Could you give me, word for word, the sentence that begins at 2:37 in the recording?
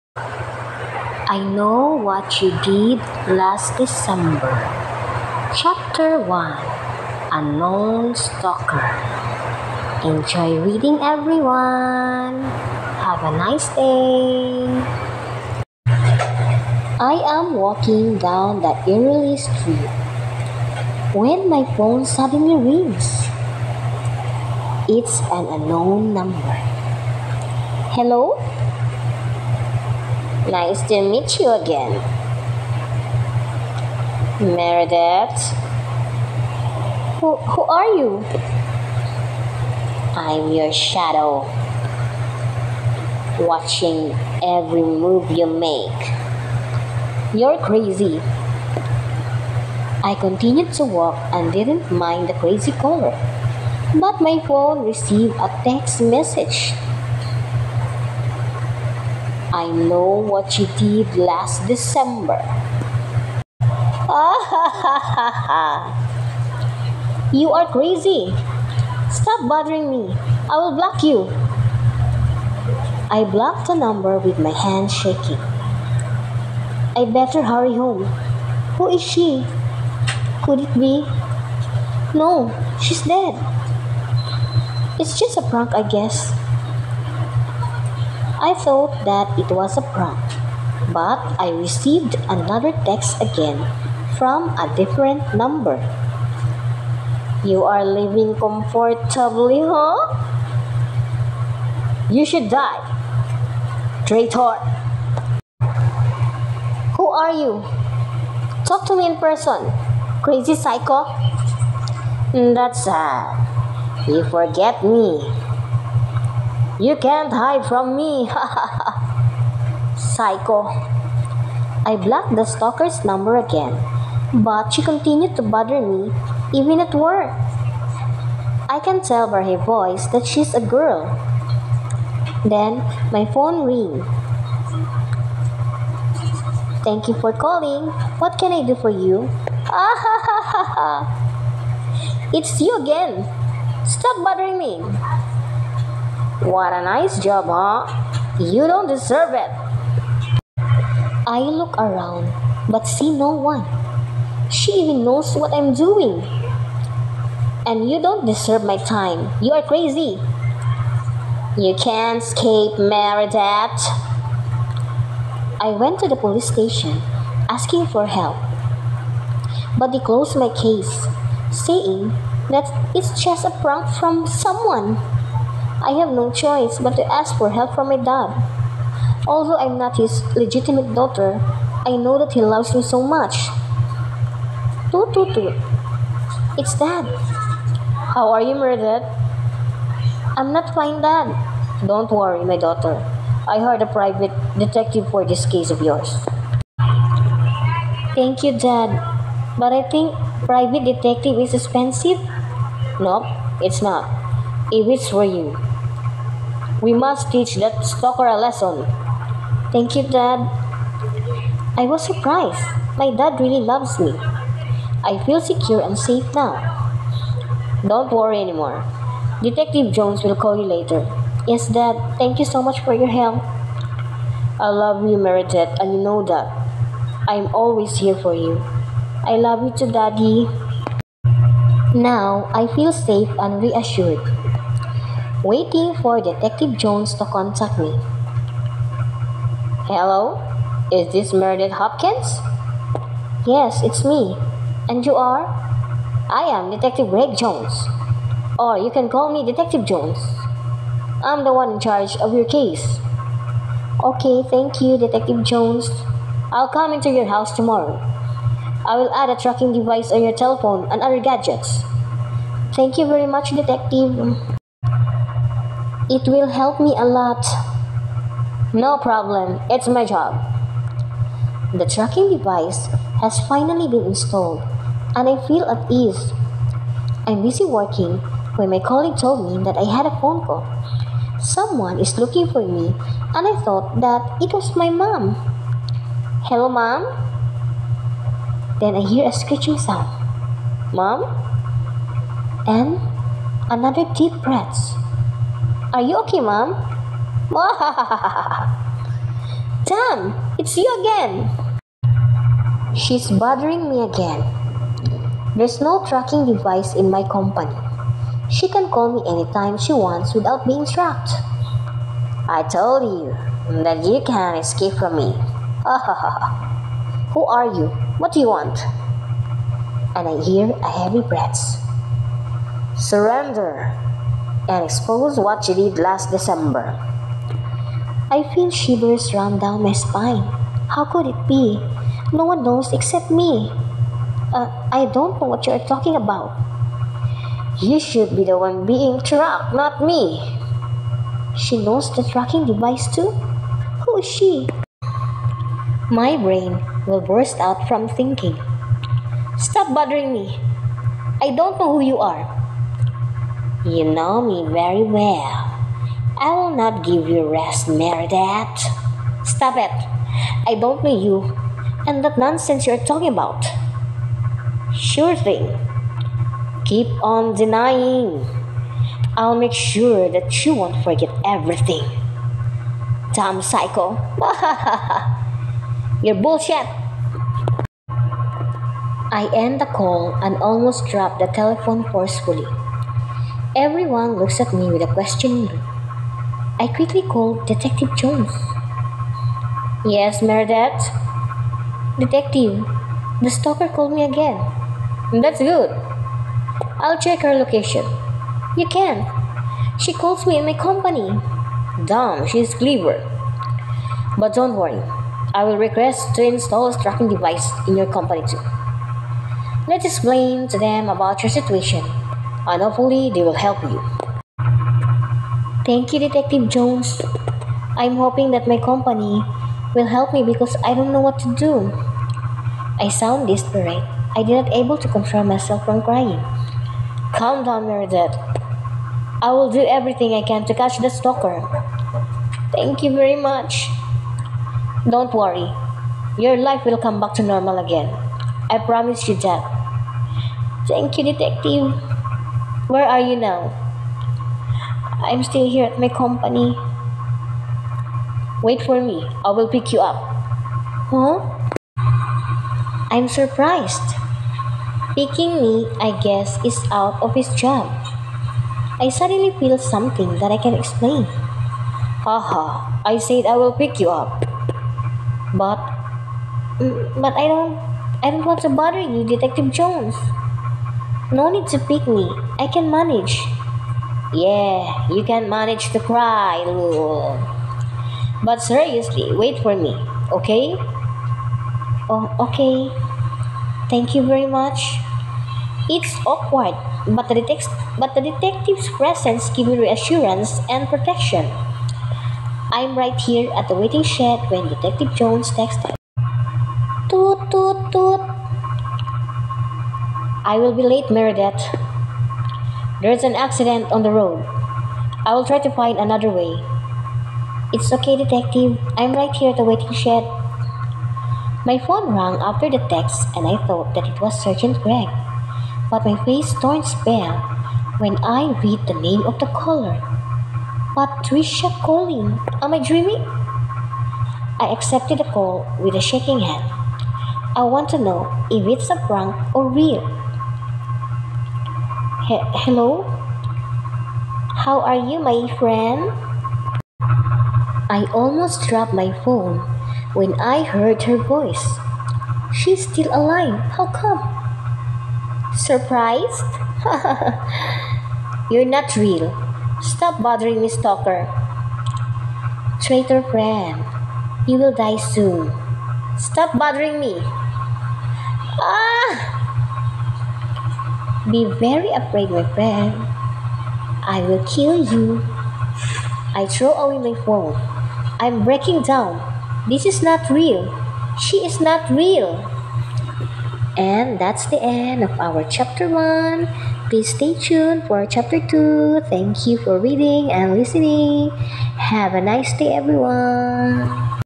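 And you don't deserve my time.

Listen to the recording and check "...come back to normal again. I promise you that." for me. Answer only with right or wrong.
right.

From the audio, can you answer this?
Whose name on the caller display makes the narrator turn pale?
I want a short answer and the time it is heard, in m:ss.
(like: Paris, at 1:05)
Patricia, at 8:40.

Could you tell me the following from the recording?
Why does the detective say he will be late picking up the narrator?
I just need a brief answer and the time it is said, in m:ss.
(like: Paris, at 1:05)
An accident on the road, at 8:23.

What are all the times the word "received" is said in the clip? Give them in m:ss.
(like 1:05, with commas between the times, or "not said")
0:54, 1:31.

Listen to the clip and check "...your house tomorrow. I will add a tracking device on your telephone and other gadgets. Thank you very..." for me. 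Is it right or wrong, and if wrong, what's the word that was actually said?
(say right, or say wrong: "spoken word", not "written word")
right.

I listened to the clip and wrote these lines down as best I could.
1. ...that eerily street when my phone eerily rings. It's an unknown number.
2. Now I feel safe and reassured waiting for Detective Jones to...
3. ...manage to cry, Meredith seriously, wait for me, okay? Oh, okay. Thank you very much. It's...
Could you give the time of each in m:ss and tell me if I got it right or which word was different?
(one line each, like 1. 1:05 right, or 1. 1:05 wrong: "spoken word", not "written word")
1. 0:18 wrong: "suddenly", not "eerily"
2. 3:51 right
3. 7:55 wrong: "But", not "Meredith".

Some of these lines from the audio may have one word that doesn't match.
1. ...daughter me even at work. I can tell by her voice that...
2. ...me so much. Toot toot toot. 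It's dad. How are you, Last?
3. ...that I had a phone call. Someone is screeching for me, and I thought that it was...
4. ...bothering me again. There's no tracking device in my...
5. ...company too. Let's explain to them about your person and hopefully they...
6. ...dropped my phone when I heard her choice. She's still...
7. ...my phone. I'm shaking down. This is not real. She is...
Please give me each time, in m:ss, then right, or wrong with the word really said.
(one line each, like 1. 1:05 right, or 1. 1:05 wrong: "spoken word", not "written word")
1. 2:05 wrong: "bother", not "daughter"
2. 3:02 wrong: "Meredith", not "Last"
3. 4:39 wrong: "looking", not "screeching"
4. 5:03 right
5. 6:48 wrong: "situation", not "person"
6. 8:58 wrong: "voice", not "choice"
7. 9:27 wrong: "breaking", not "shaking".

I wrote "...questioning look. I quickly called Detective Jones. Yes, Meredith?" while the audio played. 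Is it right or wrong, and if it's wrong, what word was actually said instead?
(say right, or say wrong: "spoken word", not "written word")
right.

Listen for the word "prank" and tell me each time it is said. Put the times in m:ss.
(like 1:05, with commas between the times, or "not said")
1:25, 1:29, 2:53, 8:49.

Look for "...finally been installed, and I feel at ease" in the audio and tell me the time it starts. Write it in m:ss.
4:33.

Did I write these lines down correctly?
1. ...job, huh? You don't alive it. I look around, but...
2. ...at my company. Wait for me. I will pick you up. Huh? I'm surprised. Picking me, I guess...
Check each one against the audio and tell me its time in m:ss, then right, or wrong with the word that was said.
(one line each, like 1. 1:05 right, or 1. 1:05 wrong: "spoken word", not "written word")
1. 2:27 wrong: "deserve", not "alive"
2. 7:25 right.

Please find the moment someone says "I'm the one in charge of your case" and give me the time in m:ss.
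4:11.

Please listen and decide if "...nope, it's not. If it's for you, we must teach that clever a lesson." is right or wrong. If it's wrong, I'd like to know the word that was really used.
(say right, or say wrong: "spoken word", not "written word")
wrong: "stalker", not "clever".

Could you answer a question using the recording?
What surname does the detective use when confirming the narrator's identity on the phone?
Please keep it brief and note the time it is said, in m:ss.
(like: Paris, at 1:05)
Hopkins, at 4:01.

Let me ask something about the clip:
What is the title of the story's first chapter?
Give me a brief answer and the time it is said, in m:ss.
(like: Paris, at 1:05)
Unknown Stalker, at 0:07.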